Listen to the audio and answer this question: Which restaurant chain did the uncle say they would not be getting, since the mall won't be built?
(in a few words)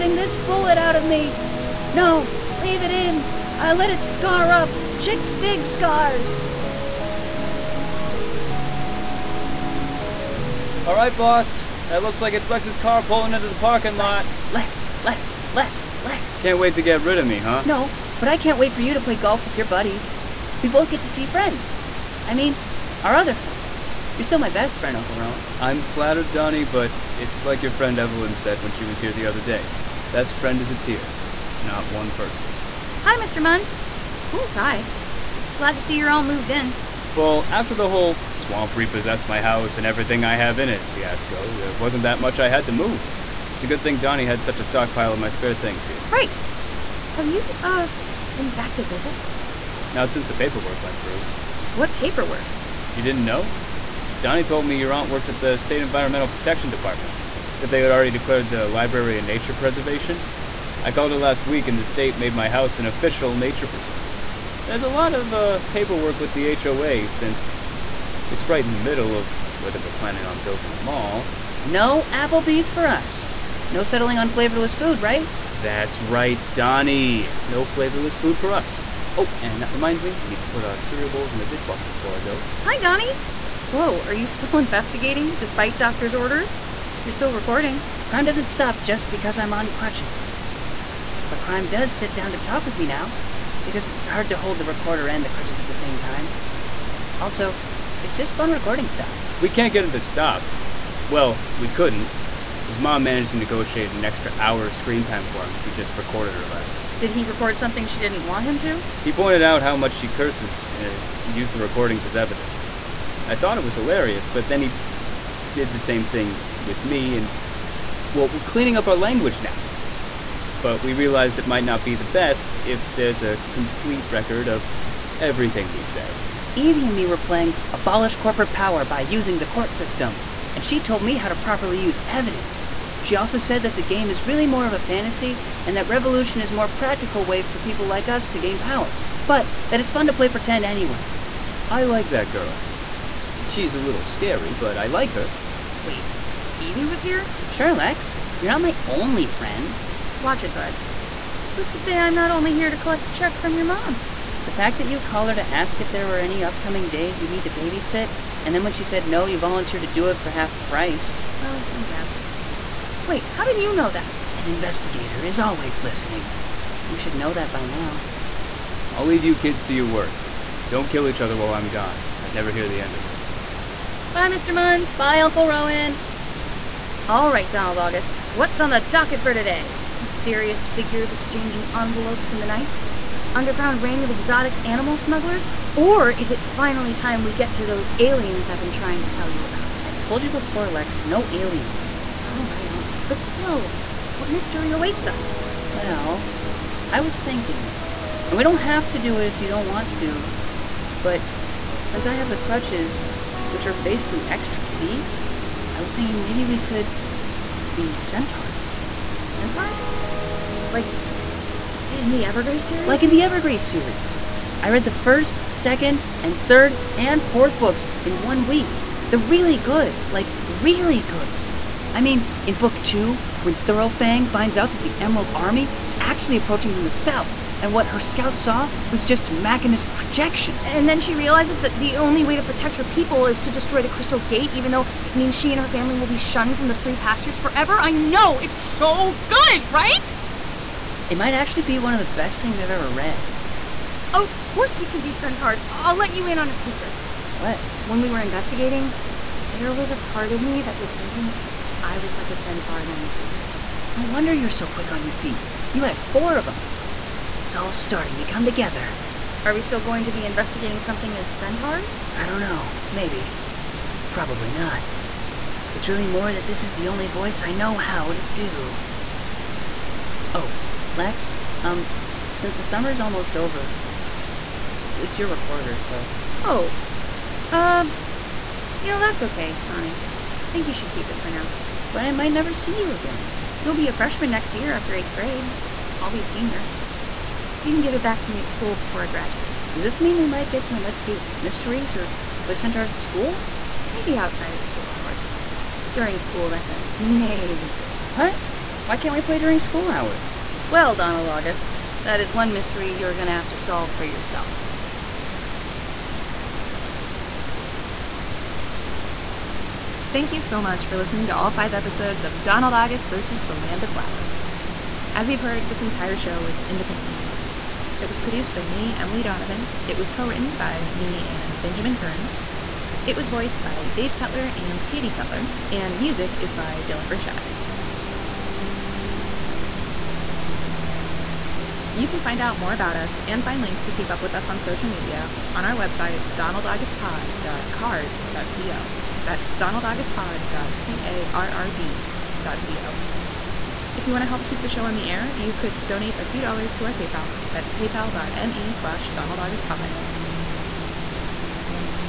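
Applebee's.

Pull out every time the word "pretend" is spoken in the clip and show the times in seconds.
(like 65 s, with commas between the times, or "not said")
140 s.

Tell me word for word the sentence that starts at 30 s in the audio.
Best friend is a tier, not one person.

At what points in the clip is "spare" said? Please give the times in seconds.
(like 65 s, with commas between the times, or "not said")
45 s.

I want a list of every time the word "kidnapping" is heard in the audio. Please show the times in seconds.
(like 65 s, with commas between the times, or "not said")
not said.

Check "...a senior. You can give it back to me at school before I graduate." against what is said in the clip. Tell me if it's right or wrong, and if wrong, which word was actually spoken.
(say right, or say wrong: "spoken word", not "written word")
right.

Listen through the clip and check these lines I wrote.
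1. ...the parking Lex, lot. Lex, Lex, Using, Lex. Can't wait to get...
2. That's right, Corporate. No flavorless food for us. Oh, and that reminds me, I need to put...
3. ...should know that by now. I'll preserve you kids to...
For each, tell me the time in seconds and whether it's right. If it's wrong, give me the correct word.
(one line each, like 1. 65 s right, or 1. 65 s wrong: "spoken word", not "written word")
1. 13 s wrong: "Lex", not "Using"
2. 75 s wrong: "Donnie", not "Corporate"
3. 166 s wrong: "leave", not "preserve".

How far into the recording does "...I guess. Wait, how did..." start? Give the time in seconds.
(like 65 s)
161 s.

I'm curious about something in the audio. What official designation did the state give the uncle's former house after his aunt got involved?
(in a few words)
Nature preserve.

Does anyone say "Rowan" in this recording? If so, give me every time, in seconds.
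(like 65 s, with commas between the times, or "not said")
25 s, 175 s.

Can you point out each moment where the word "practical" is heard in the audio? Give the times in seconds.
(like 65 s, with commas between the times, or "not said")
136 s.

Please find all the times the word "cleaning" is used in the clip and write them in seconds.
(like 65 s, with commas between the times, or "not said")
118 s.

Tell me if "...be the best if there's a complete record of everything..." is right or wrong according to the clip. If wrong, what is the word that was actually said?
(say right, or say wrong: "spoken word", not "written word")
right.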